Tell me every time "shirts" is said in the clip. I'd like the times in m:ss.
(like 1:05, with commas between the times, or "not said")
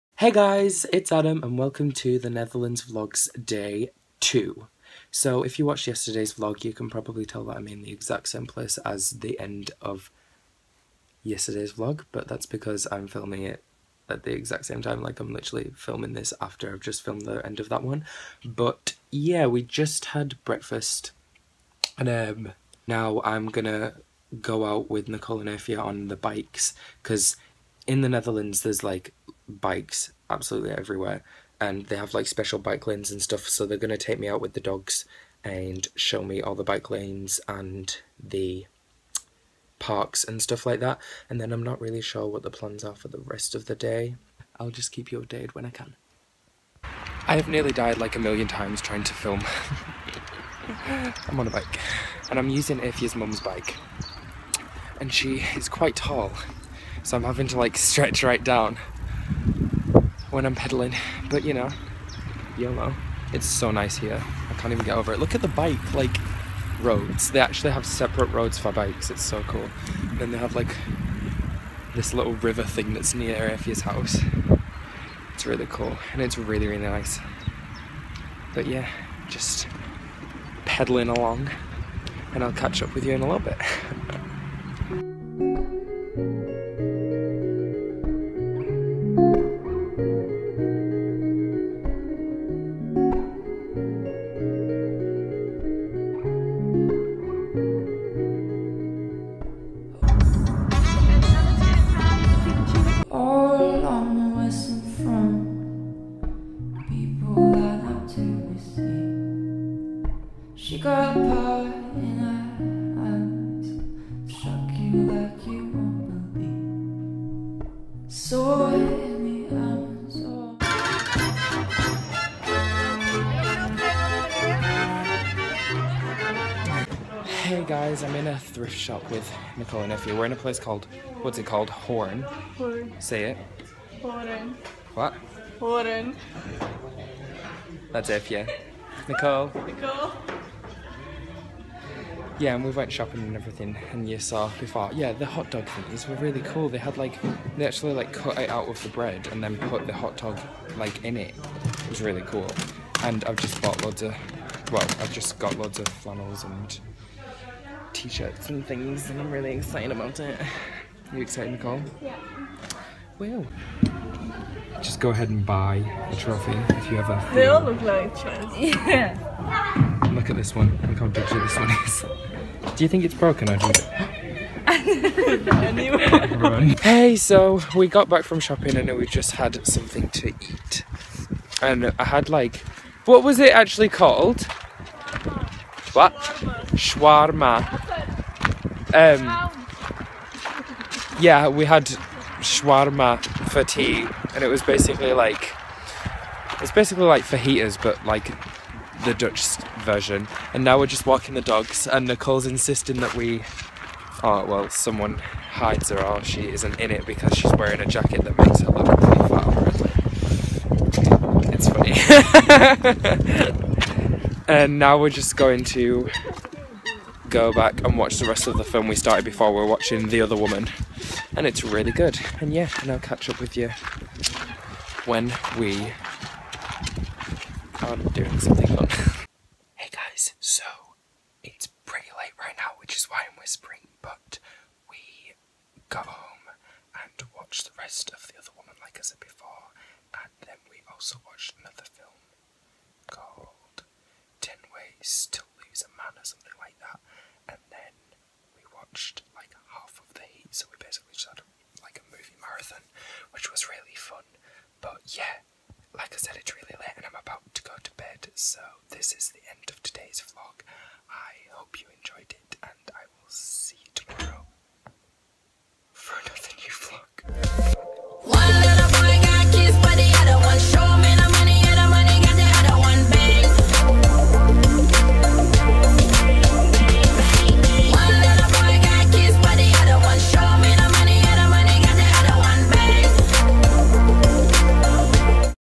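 2:37.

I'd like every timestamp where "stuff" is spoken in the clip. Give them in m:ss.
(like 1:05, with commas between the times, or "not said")
0:33, 0:40.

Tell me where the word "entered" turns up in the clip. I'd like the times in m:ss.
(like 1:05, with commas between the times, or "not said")
not said.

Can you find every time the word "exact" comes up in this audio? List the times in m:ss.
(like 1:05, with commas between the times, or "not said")
0:07, 0:14.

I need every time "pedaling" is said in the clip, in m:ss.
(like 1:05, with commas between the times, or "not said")
1:00, 1:20.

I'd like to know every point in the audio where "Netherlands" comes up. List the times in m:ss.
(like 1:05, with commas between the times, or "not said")
0:02, 0:28.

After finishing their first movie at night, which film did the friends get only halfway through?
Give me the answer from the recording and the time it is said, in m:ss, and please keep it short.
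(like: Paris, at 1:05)
The Heat, at 4:10.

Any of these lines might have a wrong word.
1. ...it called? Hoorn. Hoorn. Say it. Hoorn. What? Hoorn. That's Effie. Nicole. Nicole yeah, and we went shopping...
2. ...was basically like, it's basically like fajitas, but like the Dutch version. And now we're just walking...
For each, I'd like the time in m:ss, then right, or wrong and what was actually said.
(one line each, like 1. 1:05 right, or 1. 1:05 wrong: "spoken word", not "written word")
1. 2:11 right
2. 3:14 right.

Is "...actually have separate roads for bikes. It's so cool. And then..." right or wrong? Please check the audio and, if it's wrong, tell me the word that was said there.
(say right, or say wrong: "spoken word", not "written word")
right.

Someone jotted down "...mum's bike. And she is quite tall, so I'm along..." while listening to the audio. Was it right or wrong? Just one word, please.
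wrong.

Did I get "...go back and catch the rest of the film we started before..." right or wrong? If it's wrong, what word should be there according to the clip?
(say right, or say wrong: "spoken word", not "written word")
wrong: "watch", not "catch".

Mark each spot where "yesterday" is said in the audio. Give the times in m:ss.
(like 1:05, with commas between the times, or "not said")
0:05, 0:11.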